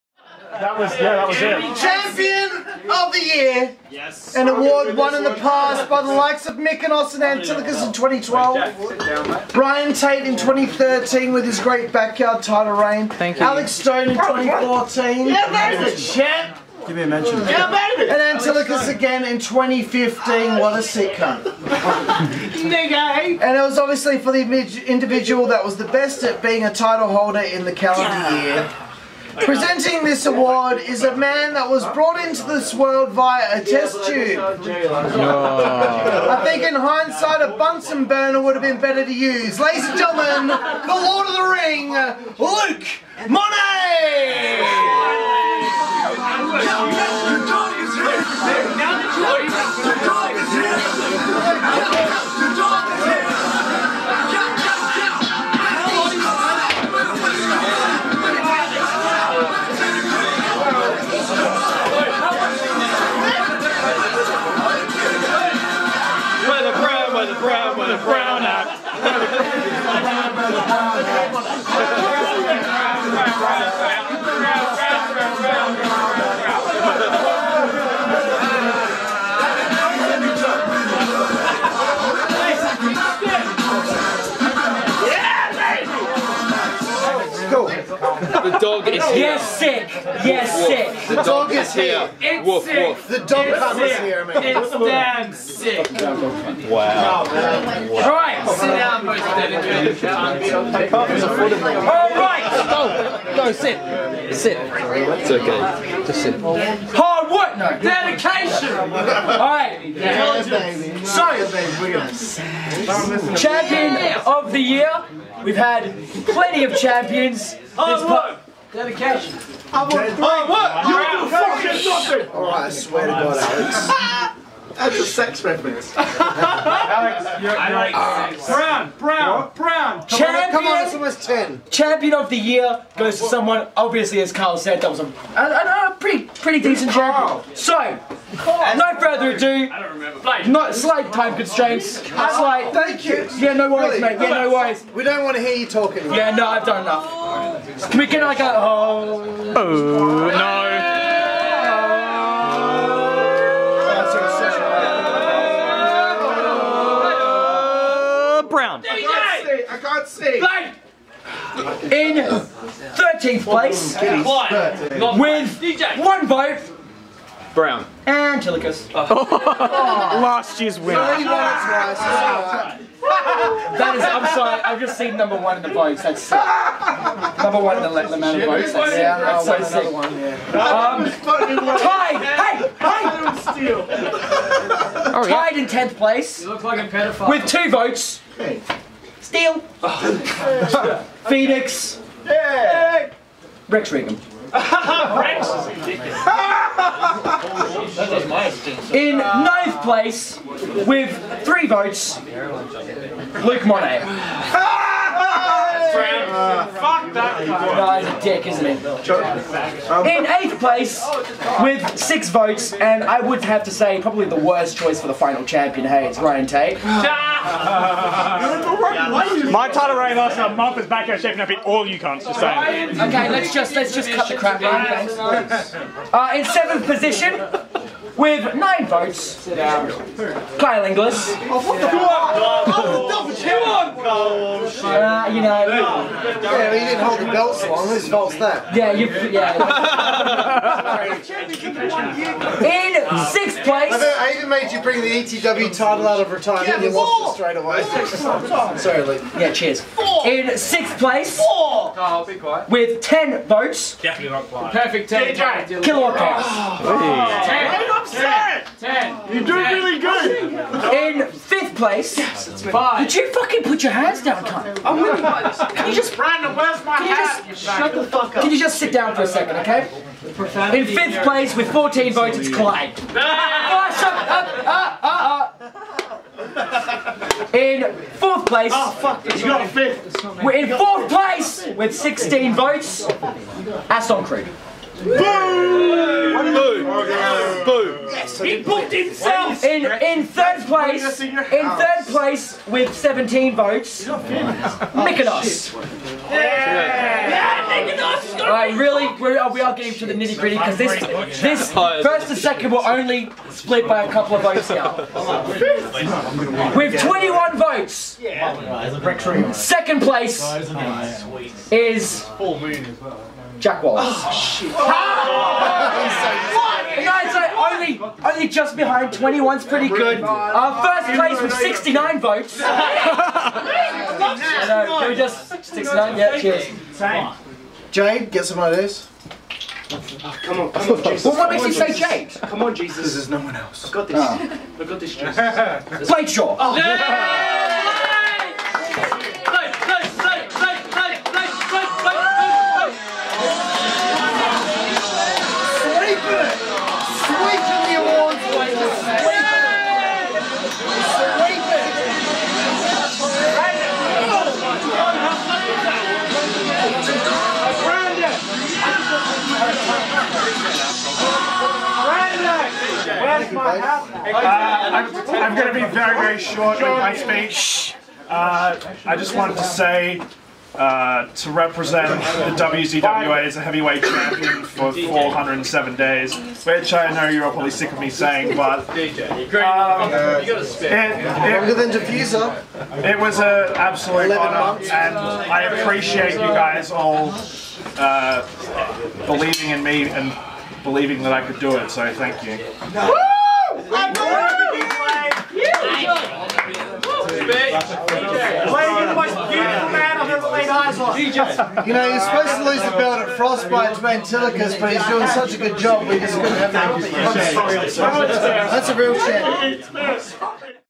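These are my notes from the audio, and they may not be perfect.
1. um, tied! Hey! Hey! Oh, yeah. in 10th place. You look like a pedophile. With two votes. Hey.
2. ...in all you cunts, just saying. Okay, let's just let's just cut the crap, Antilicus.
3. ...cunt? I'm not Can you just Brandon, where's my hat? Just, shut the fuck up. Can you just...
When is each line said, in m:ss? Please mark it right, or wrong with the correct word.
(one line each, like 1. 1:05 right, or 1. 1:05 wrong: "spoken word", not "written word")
1. 3:00 right
2. 3:41 wrong: "Ryan", not "Antilicus"
3. 4:24 right.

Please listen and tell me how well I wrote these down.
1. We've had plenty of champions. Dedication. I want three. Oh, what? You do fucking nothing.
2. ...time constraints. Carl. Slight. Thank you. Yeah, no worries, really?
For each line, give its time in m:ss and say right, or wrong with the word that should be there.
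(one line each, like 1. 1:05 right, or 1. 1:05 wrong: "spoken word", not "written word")
1. 1:55 right
2. 2:21 right.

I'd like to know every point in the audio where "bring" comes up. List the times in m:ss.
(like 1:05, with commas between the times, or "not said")
4:04.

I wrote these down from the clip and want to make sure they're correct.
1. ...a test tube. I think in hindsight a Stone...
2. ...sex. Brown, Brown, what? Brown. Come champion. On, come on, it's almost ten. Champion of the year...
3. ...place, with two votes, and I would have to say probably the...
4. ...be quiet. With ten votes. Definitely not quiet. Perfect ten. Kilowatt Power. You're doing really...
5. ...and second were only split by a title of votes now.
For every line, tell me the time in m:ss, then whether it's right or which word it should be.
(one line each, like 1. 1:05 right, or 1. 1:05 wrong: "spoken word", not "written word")
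1. 0:33 wrong: "Bunsen", not "Stone"
2. 2:08 right
3. 3:30 wrong: "six", not "two"
4. 4:12 right
5. 5:02 wrong: "couple", not "title".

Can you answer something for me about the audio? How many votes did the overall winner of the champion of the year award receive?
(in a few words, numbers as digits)
69.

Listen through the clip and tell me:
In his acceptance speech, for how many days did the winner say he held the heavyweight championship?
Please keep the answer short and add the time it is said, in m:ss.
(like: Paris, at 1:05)
407, at 6:14.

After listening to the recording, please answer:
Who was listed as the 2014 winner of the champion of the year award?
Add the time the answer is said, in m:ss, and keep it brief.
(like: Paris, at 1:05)
Alex Stone, at 0:13.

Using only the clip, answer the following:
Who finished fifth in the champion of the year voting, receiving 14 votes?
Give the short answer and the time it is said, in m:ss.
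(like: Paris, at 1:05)
Clyde, at 4:32.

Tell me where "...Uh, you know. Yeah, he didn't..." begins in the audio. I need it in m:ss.
3:54.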